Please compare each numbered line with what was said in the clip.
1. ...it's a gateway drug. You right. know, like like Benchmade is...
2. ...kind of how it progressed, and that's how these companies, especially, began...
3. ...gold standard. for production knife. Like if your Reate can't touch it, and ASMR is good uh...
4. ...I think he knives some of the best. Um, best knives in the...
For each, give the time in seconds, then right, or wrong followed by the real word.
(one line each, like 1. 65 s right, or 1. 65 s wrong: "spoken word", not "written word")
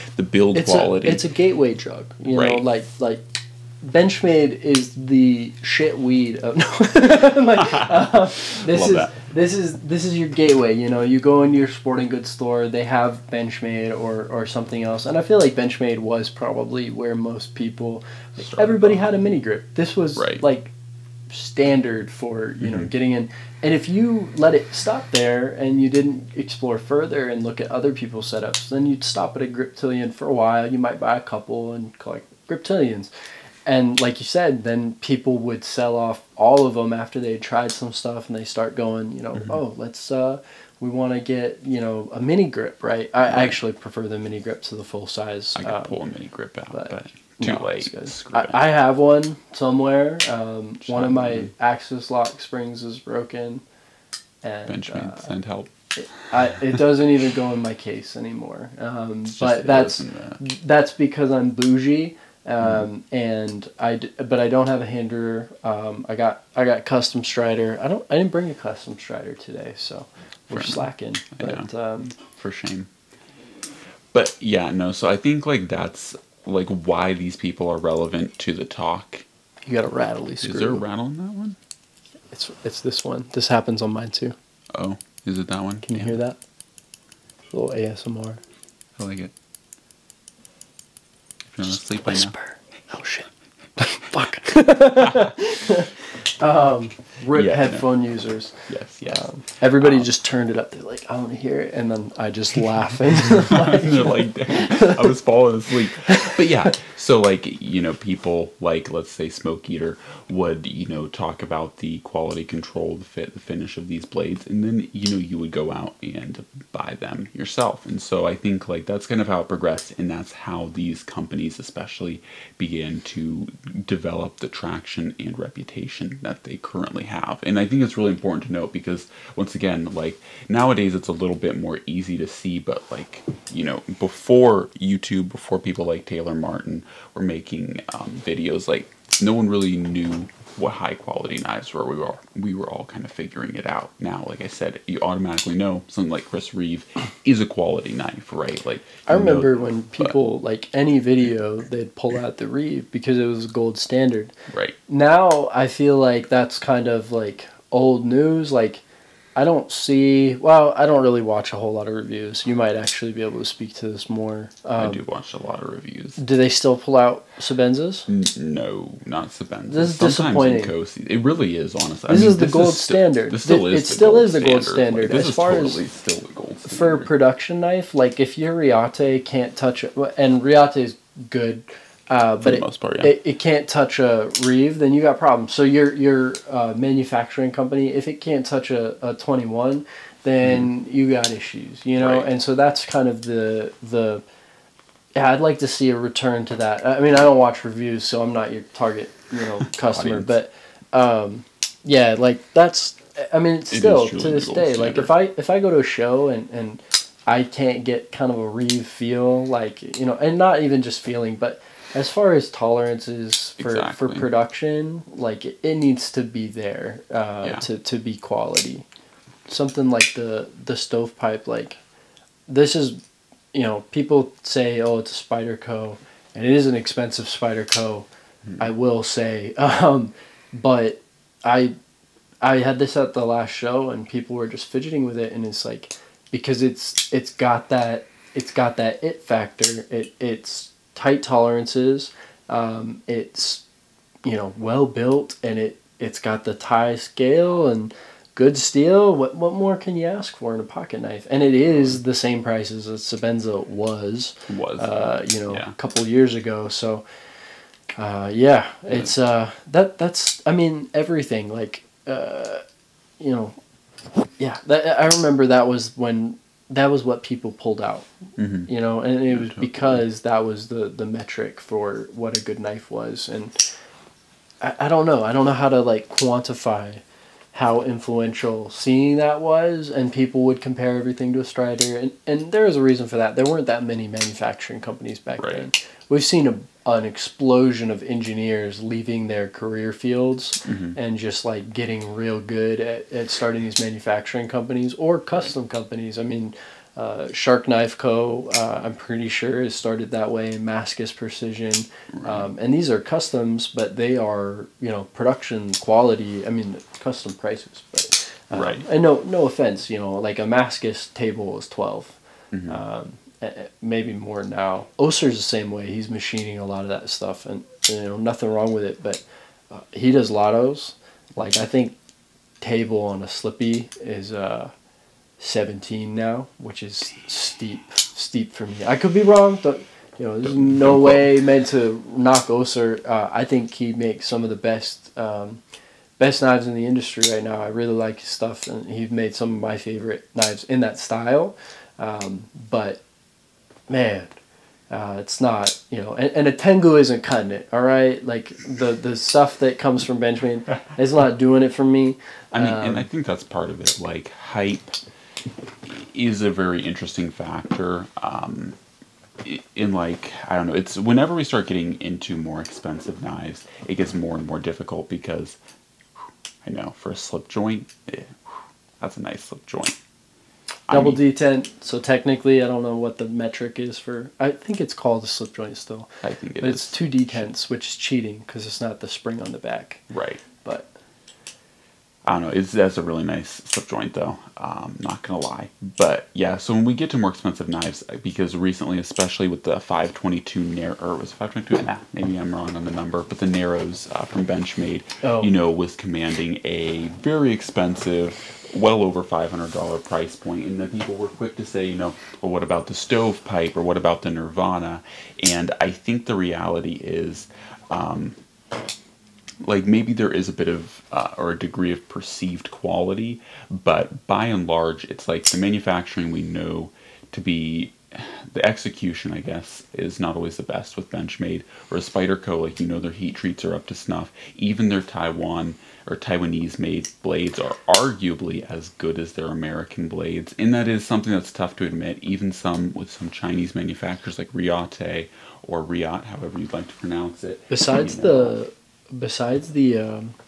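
1. 1 s right
2. 119 s right
3. 176 s wrong: "Reate", not "ASMR"
4. 333 s wrong: "makes", not "knives".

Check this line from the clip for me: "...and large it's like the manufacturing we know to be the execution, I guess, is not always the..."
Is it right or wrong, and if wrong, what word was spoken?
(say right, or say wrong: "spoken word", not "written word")
right.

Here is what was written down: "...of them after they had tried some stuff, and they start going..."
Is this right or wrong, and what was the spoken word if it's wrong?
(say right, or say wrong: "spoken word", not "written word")
right.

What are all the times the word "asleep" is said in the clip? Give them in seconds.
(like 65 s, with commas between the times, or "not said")
91 s, 105 s.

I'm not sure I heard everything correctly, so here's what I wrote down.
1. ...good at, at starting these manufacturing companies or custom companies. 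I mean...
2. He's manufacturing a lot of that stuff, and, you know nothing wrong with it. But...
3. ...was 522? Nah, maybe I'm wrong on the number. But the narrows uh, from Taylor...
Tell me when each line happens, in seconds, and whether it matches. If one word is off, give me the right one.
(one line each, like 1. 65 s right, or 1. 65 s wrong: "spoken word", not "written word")
1. 292 s right
2. 315 s wrong: "machining", not "manufacturing"
3. 391 s wrong: "Benchmade", not "Taylor".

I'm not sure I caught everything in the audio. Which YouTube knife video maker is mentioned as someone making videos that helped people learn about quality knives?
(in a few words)
Taylor Martin.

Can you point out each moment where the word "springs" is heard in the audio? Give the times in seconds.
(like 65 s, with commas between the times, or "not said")
52 s, 379 s.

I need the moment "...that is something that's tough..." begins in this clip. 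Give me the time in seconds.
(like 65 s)
430 s.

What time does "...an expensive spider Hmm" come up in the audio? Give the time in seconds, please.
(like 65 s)
226 s.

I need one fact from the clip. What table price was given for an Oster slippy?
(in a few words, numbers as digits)
17.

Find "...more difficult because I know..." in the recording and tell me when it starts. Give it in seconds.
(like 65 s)
364 s.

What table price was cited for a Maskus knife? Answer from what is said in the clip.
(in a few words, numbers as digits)
12.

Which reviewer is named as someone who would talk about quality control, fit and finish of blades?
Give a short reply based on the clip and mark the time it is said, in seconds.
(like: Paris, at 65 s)
Smoke Eater, at 109 s.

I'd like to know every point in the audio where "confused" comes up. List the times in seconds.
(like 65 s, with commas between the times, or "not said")
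not said.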